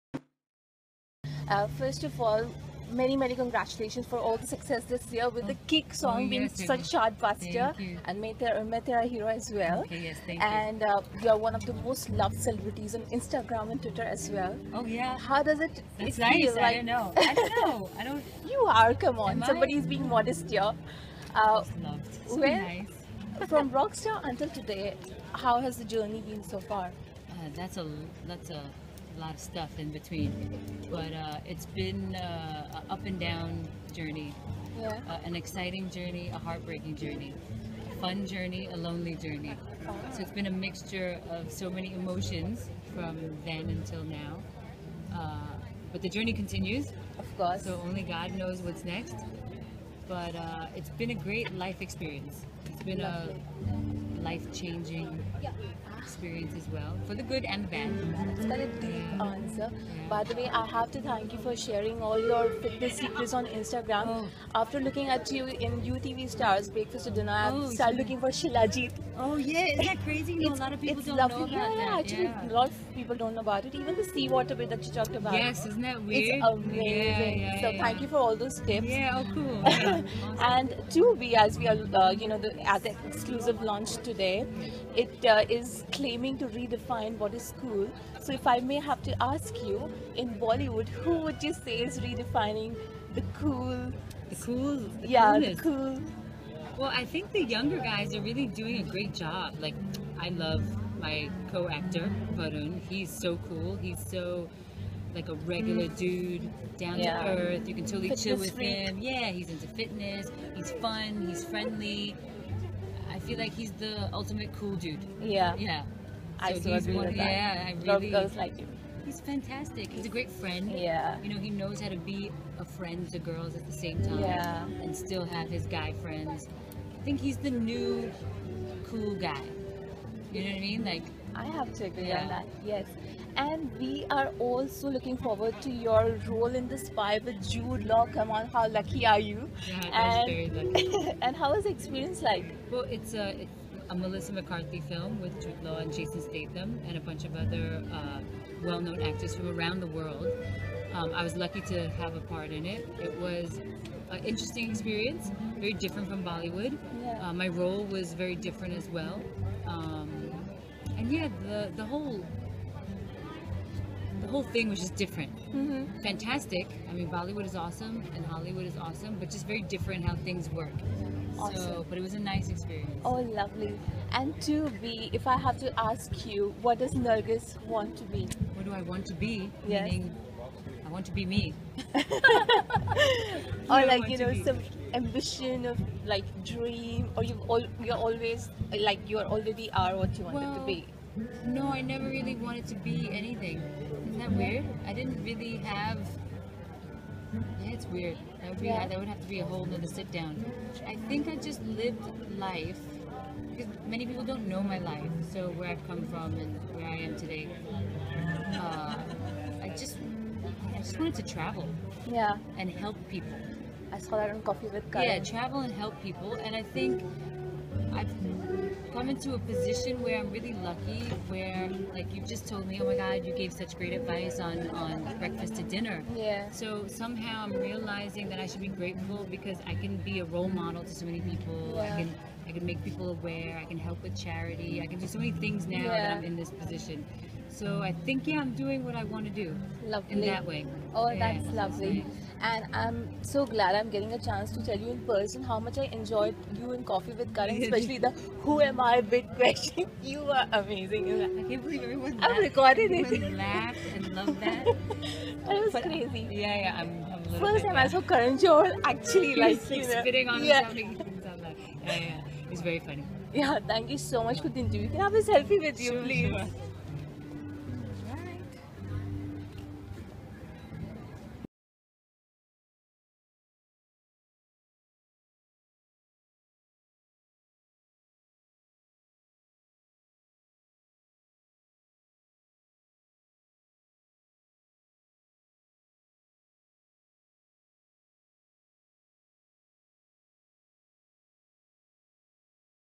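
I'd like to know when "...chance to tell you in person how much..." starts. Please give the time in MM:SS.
04:04.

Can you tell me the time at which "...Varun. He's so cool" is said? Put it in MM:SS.
01:42.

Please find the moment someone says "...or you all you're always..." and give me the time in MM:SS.
03:07.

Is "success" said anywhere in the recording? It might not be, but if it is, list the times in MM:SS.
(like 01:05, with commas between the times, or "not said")
00:04.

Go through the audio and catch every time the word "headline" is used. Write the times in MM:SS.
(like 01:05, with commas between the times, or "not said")
not said.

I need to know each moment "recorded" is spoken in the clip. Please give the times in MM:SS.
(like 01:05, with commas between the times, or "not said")
04:12.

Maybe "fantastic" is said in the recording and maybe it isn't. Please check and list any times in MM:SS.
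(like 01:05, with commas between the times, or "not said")
01:59, 02:46.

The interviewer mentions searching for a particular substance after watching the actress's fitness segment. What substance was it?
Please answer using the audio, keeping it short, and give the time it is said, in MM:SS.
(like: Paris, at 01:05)
Shilajit, at 01:08.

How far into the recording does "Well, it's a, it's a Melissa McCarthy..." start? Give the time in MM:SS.
02:22.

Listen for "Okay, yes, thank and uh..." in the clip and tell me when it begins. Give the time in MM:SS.
00:09.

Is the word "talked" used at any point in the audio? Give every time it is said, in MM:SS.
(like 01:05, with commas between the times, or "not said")
01:14.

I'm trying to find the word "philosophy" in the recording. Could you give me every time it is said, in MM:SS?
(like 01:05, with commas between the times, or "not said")
not said.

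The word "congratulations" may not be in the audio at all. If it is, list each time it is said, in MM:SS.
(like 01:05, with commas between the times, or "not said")
00:03.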